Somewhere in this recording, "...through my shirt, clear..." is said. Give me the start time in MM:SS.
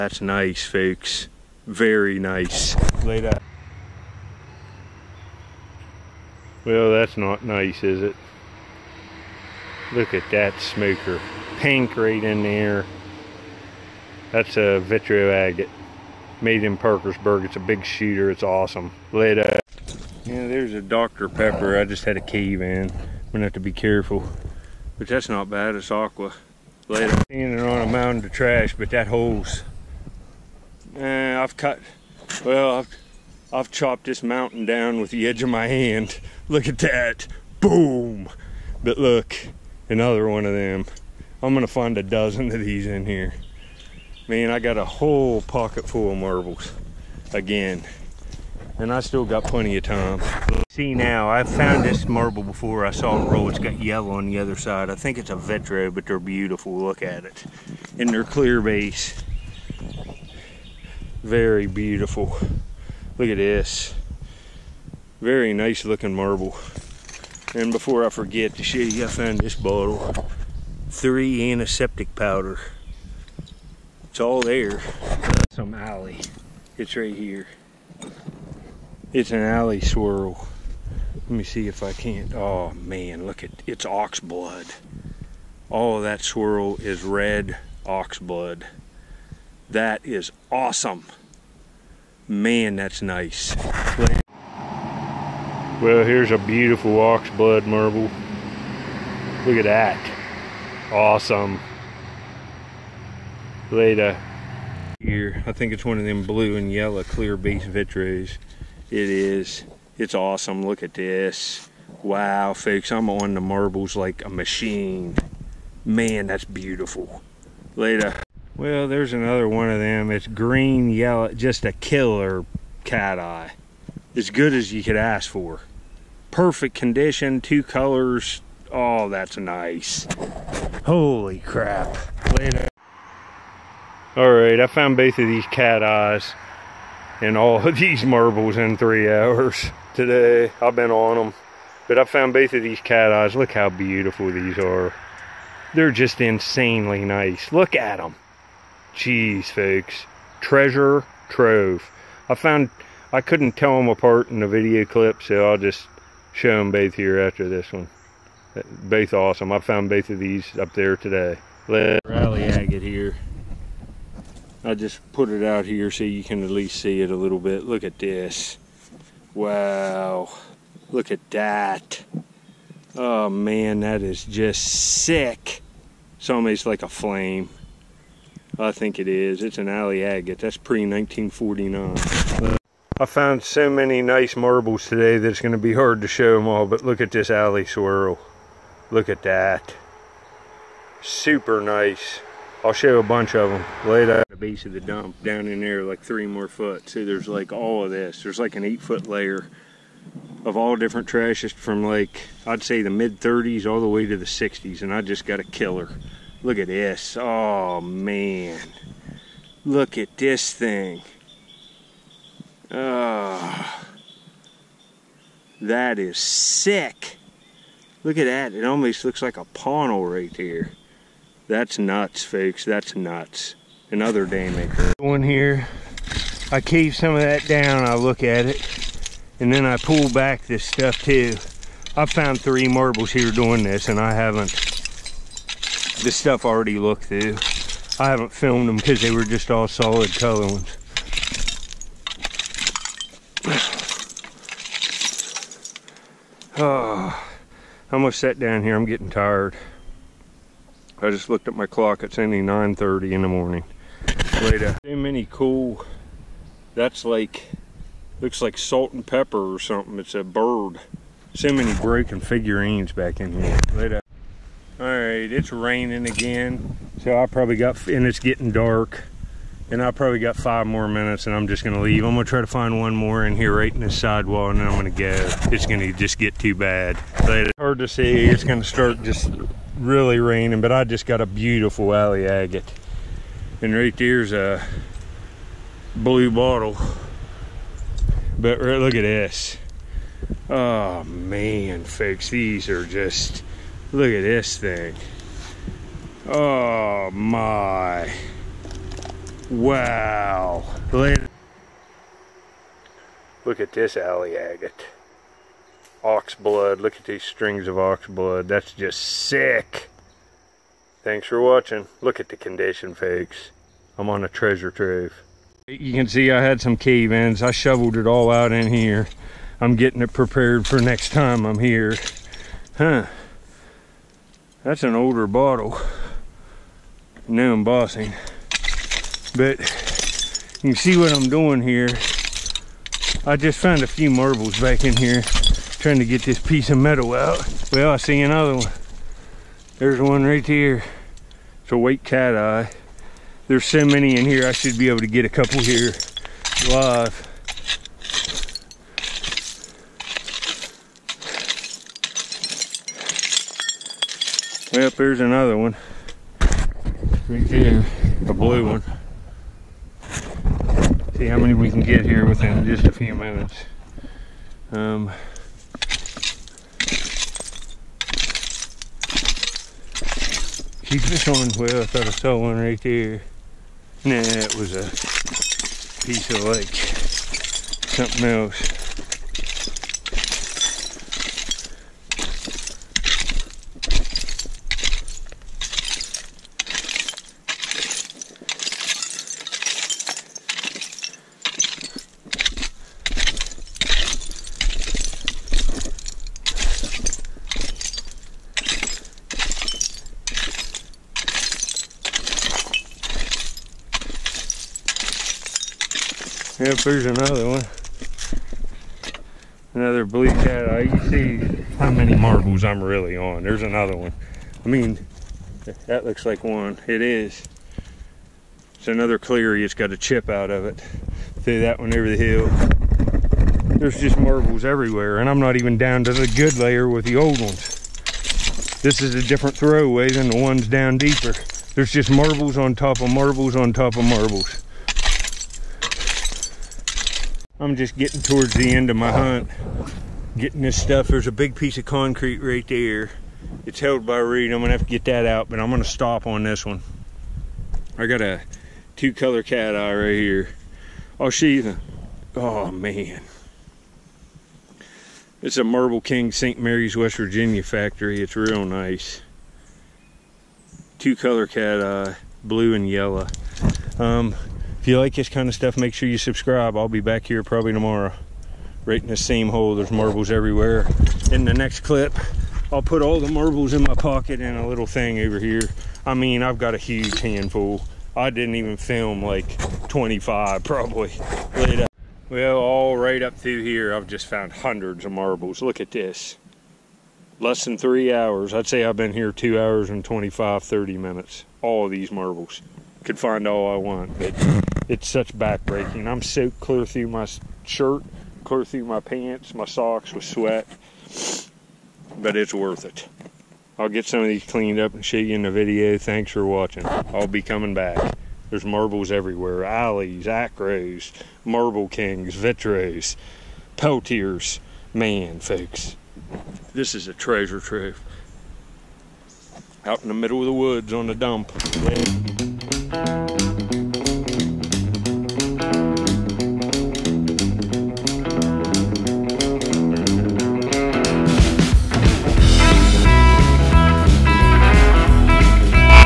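08:16.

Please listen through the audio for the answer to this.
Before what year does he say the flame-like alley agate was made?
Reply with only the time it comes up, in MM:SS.
03:00.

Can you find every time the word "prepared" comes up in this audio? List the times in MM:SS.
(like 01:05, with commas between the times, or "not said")
05:20.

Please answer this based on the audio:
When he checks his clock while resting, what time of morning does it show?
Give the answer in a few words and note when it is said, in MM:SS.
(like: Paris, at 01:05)
9:30, at 04:12.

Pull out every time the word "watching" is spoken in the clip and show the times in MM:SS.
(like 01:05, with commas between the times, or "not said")
05:11, 08:26.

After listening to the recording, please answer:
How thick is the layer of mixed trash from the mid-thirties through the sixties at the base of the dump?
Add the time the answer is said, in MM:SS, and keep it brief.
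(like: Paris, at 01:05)
8 feet, at 03:18.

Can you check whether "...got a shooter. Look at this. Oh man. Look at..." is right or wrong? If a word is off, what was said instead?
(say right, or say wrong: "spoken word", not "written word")
wrong: "killer", not "shooter".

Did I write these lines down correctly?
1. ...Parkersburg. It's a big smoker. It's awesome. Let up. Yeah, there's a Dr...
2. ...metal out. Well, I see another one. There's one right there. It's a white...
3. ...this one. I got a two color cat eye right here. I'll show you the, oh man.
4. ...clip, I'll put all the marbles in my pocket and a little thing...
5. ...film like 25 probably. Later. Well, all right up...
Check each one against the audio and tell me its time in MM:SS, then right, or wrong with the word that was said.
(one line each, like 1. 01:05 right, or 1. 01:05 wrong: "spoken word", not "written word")
1. 00:16 wrong: "shooter", not "smoker"
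2. 05:36 right
3. 07:26 right
4. 07:51 right
5. 07:58 right.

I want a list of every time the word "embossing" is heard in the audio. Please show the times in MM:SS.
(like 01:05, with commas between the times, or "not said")
05:27.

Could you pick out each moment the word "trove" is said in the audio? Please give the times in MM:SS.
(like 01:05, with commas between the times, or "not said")
02:31, 05:14, 08:37.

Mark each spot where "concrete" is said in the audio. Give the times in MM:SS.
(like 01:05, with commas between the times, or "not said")
07:21.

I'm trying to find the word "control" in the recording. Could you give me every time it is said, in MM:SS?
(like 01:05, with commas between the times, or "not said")
not said.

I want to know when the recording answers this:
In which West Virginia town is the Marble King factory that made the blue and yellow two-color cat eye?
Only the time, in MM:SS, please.
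07:36.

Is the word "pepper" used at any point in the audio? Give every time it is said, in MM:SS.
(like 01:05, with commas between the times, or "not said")
00:21, 04:19.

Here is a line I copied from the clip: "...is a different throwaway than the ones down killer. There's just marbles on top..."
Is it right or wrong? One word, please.
wrong.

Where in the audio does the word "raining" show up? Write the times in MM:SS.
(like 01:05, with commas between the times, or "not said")
04:25, 04:40.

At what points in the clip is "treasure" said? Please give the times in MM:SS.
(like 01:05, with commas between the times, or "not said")
02:30, 05:14, 08:37.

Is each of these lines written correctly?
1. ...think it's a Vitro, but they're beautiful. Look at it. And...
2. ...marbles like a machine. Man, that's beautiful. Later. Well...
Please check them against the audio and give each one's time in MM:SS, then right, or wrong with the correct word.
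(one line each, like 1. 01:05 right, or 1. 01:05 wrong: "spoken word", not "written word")
1. 00:54 right
2. 01:53 right.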